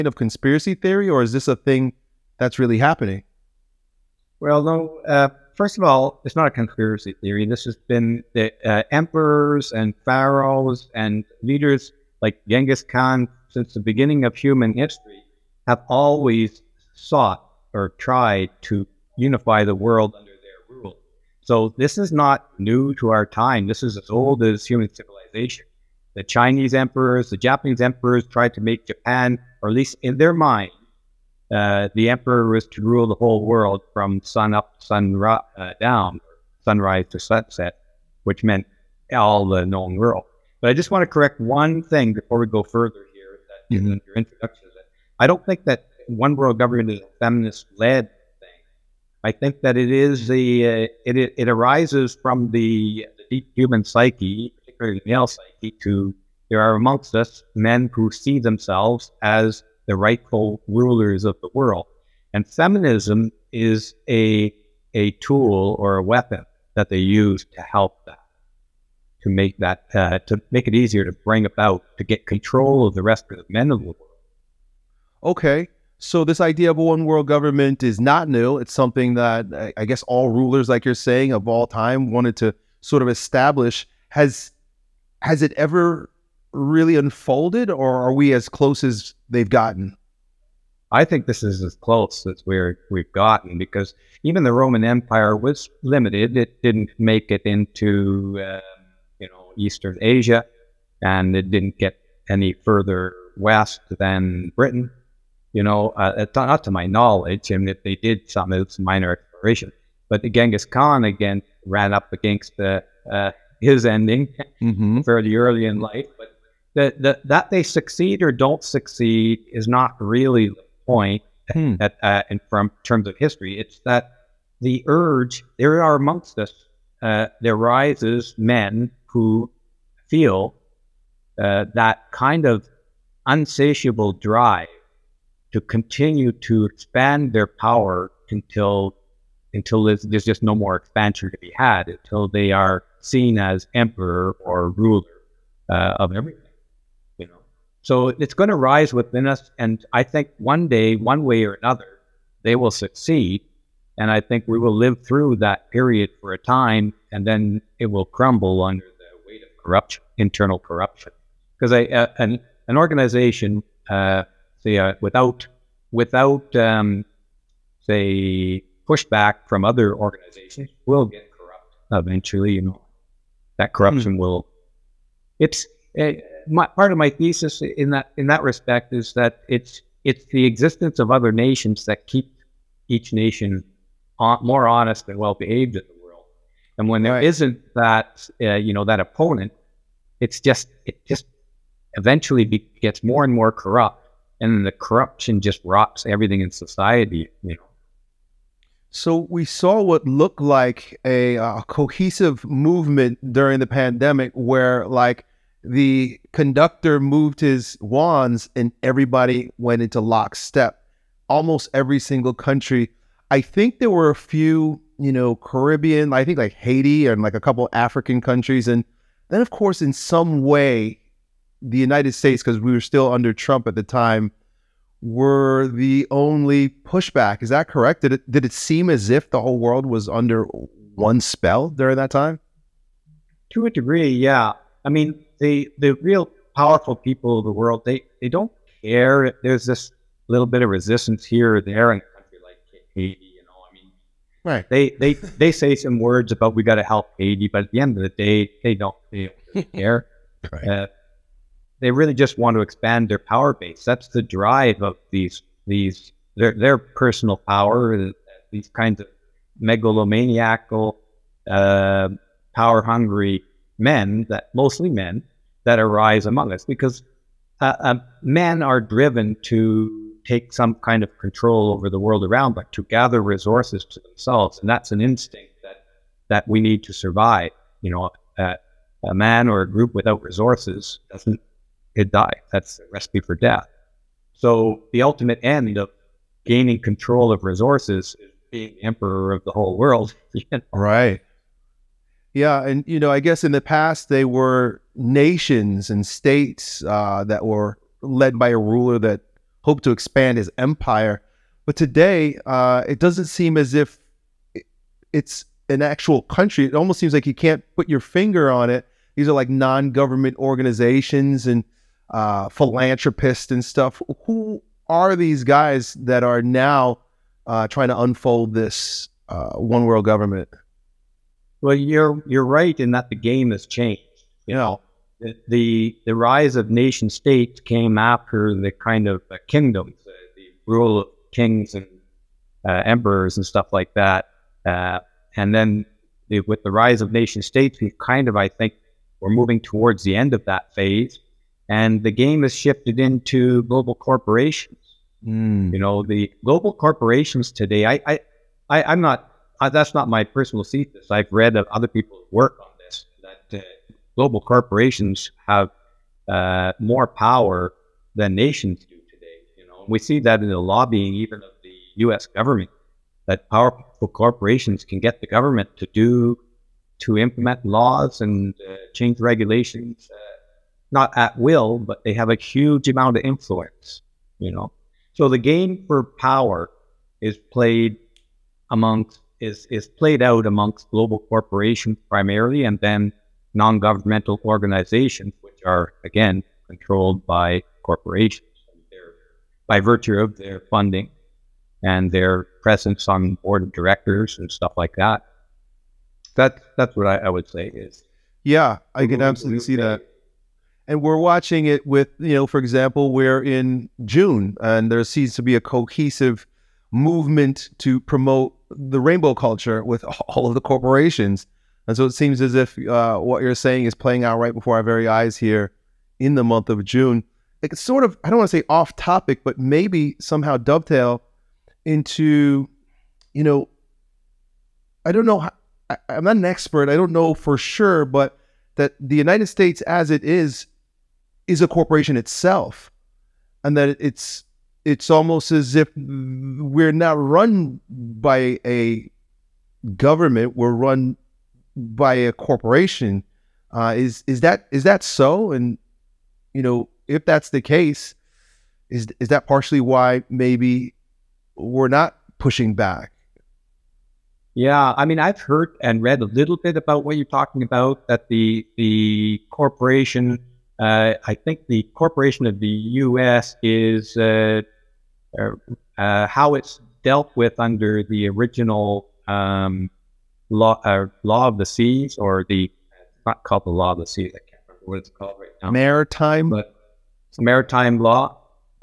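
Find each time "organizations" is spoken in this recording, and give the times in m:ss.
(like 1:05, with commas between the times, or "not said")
2:42, 2:49, 5:10, 6:24.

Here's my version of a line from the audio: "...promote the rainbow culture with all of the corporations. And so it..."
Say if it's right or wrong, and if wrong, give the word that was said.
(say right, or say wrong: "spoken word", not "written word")
right.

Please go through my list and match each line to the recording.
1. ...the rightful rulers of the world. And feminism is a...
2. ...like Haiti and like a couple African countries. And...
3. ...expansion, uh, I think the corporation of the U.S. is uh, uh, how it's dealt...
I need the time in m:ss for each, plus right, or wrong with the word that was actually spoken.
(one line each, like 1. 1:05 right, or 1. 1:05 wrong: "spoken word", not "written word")
1. 0:59 right
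2. 3:36 right
3. 7:39 wrong: "corporation", not "expansion".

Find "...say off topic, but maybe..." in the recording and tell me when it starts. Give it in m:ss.
6:58.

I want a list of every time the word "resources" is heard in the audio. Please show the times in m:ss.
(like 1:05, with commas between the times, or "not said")
4:33, 4:40, 4:47.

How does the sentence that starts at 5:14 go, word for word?
Who are these guys that are now uh, trying to unfold this uh, one world government?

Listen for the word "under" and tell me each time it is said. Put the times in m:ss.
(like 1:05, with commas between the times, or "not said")
0:20, 2:38, 3:43, 3:50, 7:47.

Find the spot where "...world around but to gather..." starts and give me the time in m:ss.
4:31.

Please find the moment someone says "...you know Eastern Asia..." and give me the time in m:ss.
1:39.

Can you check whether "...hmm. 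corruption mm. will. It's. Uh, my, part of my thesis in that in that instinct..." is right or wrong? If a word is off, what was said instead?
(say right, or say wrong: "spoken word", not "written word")
wrong: "respect", not "instinct".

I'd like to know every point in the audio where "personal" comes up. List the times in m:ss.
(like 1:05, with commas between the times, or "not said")
4:16, 5:50.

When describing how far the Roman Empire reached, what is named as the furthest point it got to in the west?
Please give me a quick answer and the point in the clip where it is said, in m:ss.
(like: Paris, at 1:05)
Britain, at 1:44.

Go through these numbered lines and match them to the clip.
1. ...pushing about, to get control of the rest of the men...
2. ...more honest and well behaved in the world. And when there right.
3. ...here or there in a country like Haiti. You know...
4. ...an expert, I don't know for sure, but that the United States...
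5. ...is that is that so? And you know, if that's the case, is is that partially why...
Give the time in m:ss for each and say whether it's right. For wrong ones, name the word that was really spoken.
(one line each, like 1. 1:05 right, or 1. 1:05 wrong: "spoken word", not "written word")
1. 1:11 wrong: "bring", not "pushing"
2. 3:04 right
3. 4:01 right
4. 7:06 right
5. 7:24 right.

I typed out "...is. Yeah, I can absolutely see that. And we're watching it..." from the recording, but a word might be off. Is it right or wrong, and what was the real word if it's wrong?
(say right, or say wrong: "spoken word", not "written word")
right.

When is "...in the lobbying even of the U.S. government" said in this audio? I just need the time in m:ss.
6:00.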